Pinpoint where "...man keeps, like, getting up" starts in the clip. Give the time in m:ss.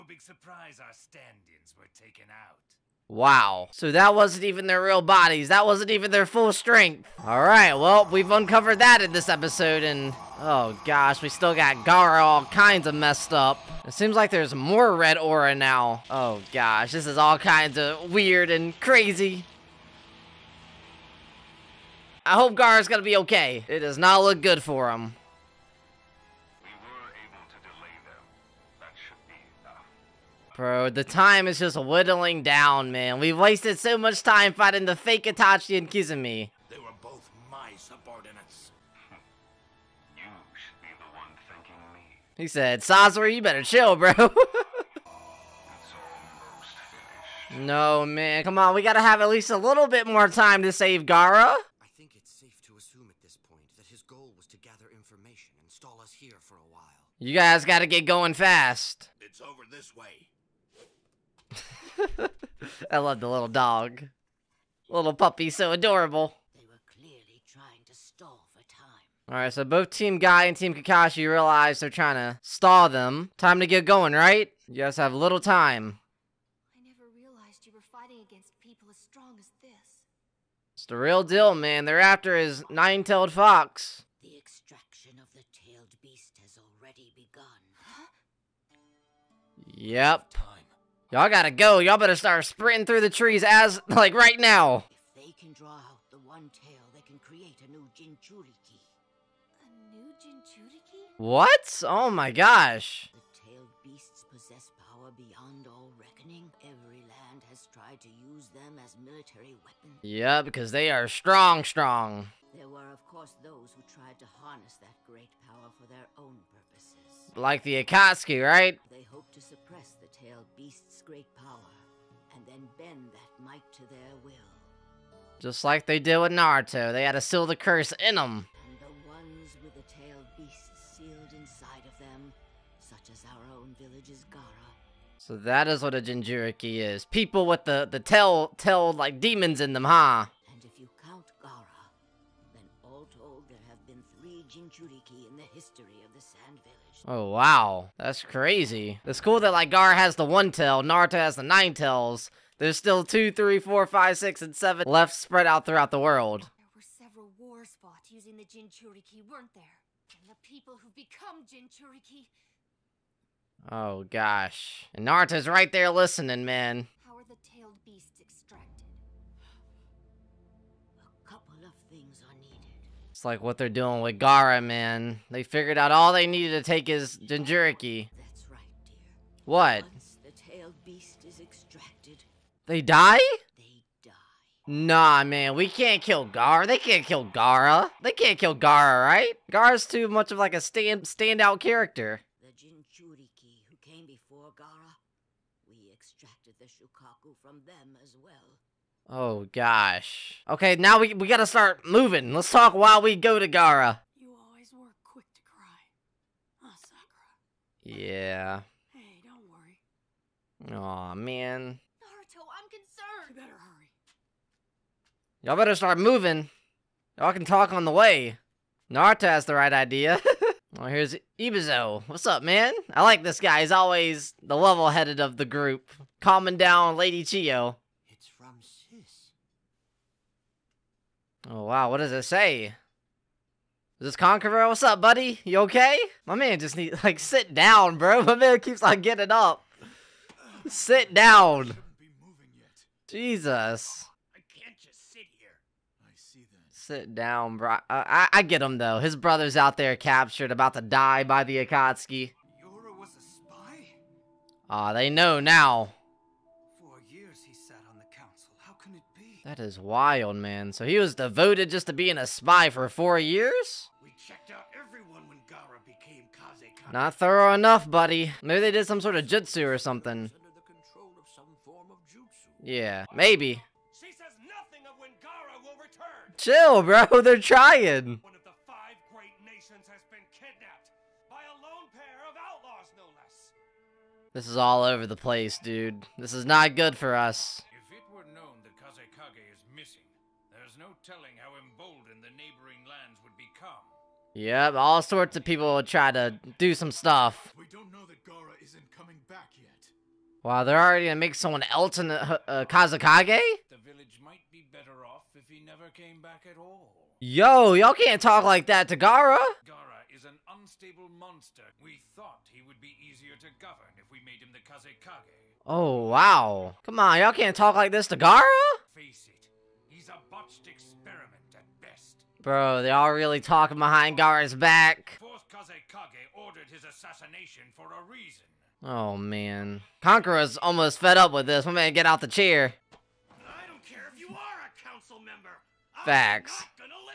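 3:58.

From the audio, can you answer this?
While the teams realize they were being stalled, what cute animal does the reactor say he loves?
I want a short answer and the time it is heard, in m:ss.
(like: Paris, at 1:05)
Little dog, at 1:03.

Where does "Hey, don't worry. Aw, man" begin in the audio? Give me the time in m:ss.
3:28.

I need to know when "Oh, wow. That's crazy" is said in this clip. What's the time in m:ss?
2:27.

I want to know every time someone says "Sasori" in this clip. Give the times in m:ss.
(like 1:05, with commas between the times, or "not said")
0:42.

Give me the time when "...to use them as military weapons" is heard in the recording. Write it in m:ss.
1:47.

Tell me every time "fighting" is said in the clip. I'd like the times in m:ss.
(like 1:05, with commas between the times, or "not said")
0:34, 1:17.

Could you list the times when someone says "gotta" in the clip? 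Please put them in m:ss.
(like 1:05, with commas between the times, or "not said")
0:48, 0:57, 1:31, 3:21.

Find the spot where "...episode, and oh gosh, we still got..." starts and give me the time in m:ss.
0:09.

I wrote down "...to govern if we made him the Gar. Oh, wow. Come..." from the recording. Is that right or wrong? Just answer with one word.
wrong.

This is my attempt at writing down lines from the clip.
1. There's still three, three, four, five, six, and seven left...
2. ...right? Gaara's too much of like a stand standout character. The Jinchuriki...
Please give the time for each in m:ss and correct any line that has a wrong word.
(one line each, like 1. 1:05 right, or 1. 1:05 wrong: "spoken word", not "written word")
1. 2:32 wrong: "two", not "three"
2. 3:09 right.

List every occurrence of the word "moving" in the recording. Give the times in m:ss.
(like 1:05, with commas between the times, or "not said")
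3:21, 3:35.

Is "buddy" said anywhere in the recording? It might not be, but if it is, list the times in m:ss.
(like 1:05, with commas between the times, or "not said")
3:55, 4:27.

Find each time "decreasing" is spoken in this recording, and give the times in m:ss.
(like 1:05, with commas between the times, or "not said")
not said.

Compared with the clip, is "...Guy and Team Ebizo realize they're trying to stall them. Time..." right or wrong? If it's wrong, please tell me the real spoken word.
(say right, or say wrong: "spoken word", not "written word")
wrong: "Kakashi", not "Ebizo".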